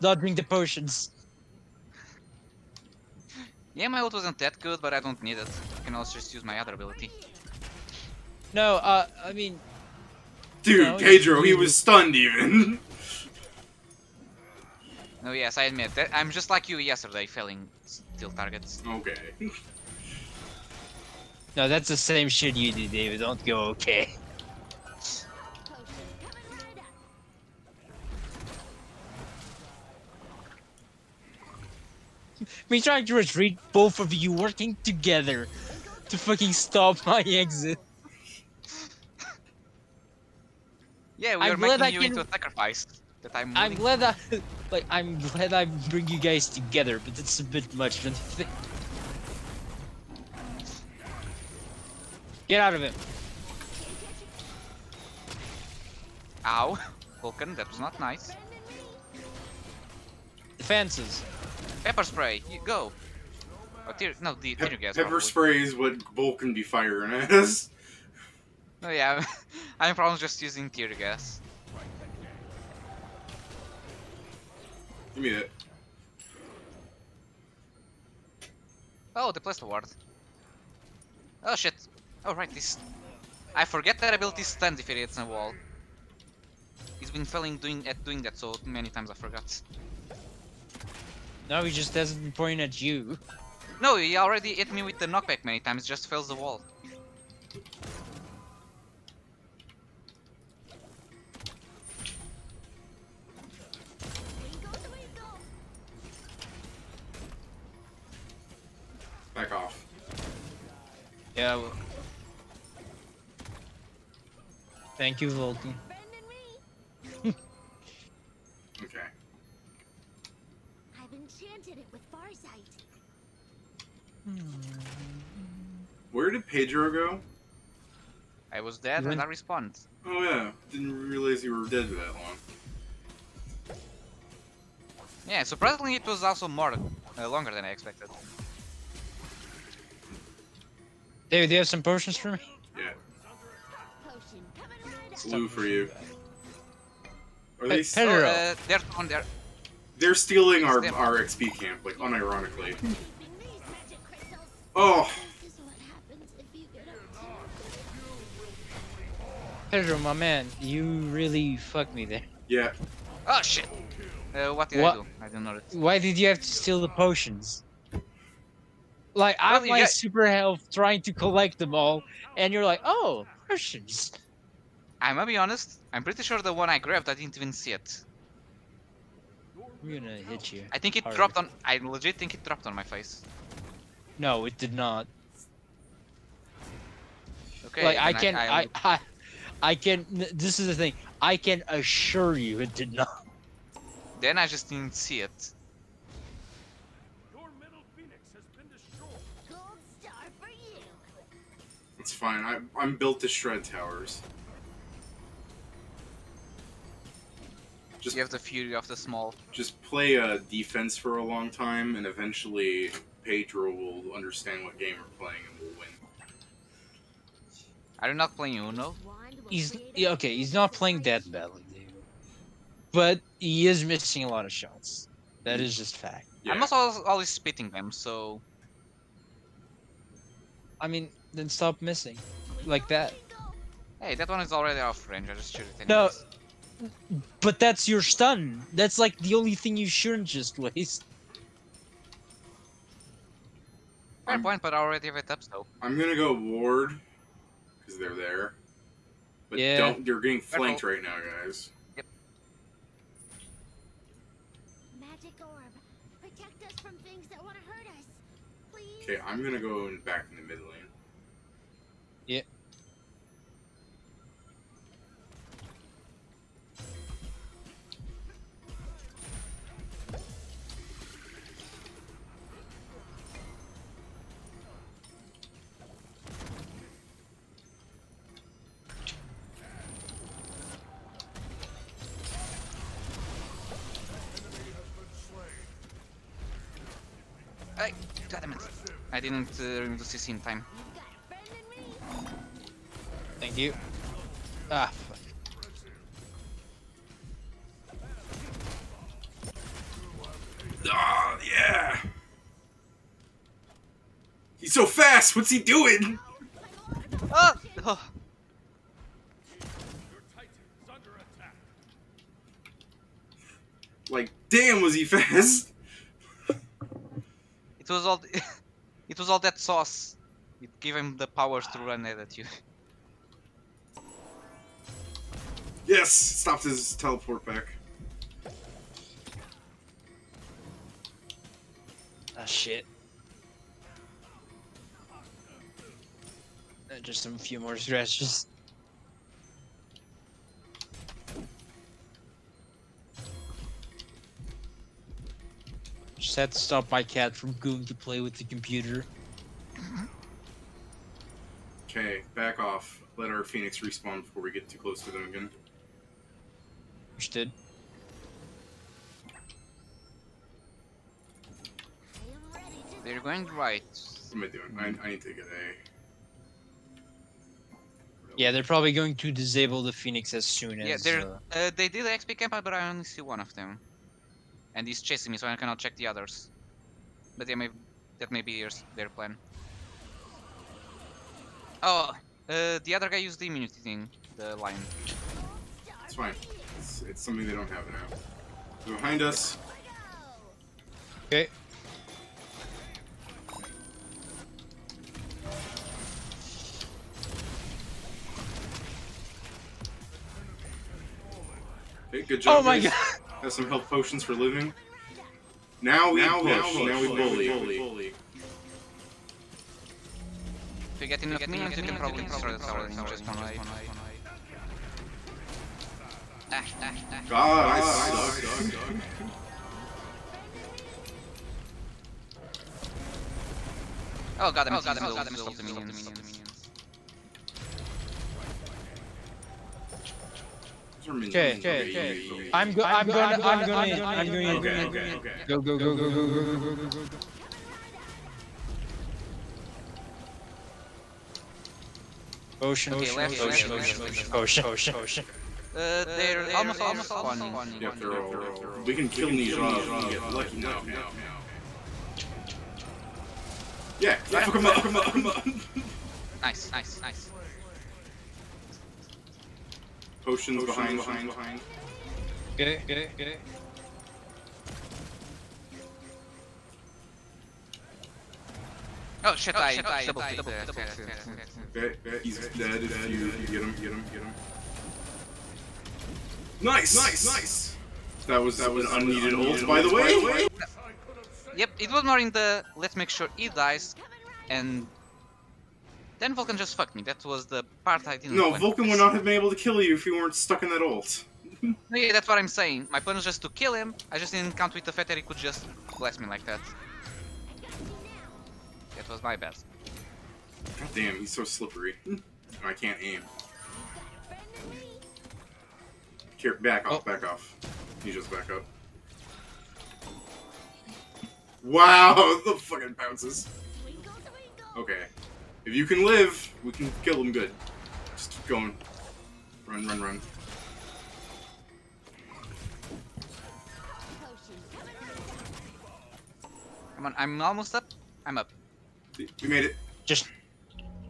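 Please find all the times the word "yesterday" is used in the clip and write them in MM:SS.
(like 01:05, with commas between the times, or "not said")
00:16.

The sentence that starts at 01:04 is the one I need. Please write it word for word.
Pepper spray is what Vulcan be firing at us.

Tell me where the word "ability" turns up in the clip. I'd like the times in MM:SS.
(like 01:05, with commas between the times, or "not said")
00:06, 01:24.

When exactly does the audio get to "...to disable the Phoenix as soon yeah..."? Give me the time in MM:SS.
06:09.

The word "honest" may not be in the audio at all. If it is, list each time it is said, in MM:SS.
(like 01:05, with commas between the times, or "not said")
02:55.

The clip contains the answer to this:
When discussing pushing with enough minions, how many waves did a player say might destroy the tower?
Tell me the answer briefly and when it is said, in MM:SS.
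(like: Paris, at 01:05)
1, at 06:53.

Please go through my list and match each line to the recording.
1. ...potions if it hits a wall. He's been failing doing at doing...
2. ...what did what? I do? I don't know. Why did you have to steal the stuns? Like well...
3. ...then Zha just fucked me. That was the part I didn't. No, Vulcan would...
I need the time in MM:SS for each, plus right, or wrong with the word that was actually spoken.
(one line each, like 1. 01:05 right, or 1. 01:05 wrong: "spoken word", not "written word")
1. 01:24 wrong: "stuns", not "potions"
2. 02:44 wrong: "potions", not "stuns"
3. 08:06 wrong: "Vulcan", not "Zha".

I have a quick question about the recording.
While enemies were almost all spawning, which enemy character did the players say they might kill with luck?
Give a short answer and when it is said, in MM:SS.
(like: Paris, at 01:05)
Ne Zha, at 07:29.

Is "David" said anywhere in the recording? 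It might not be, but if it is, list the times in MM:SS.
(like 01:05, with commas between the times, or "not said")
00:22, 02:21.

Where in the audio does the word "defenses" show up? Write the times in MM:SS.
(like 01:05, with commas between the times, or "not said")
01:00, 03:30.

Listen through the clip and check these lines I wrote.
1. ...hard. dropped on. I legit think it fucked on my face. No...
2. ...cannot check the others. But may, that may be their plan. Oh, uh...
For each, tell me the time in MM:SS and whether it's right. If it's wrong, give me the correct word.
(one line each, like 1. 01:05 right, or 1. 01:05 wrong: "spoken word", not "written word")
1. 03:01 wrong: "dropped", not "fucked"
2. 06:15 right.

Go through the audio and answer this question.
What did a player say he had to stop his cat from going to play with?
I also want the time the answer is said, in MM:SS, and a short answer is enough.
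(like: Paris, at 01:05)
The computer, at 05:48.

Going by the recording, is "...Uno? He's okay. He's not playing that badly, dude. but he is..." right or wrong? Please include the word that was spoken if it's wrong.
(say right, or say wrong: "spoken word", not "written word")
right.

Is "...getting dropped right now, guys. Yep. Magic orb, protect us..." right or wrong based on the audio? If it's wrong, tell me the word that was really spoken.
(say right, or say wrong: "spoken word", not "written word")
wrong: "flanked", not "dropped".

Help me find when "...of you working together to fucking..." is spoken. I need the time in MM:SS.
00:33.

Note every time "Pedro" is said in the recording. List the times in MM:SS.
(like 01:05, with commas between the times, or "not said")
00:10, 02:06, 02:39, 03:33.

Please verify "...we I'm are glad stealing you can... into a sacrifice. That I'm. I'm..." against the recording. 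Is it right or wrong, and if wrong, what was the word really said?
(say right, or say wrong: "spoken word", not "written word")
wrong: "making", not "stealing".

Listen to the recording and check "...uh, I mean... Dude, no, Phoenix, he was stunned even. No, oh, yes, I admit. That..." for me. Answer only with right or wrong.
wrong.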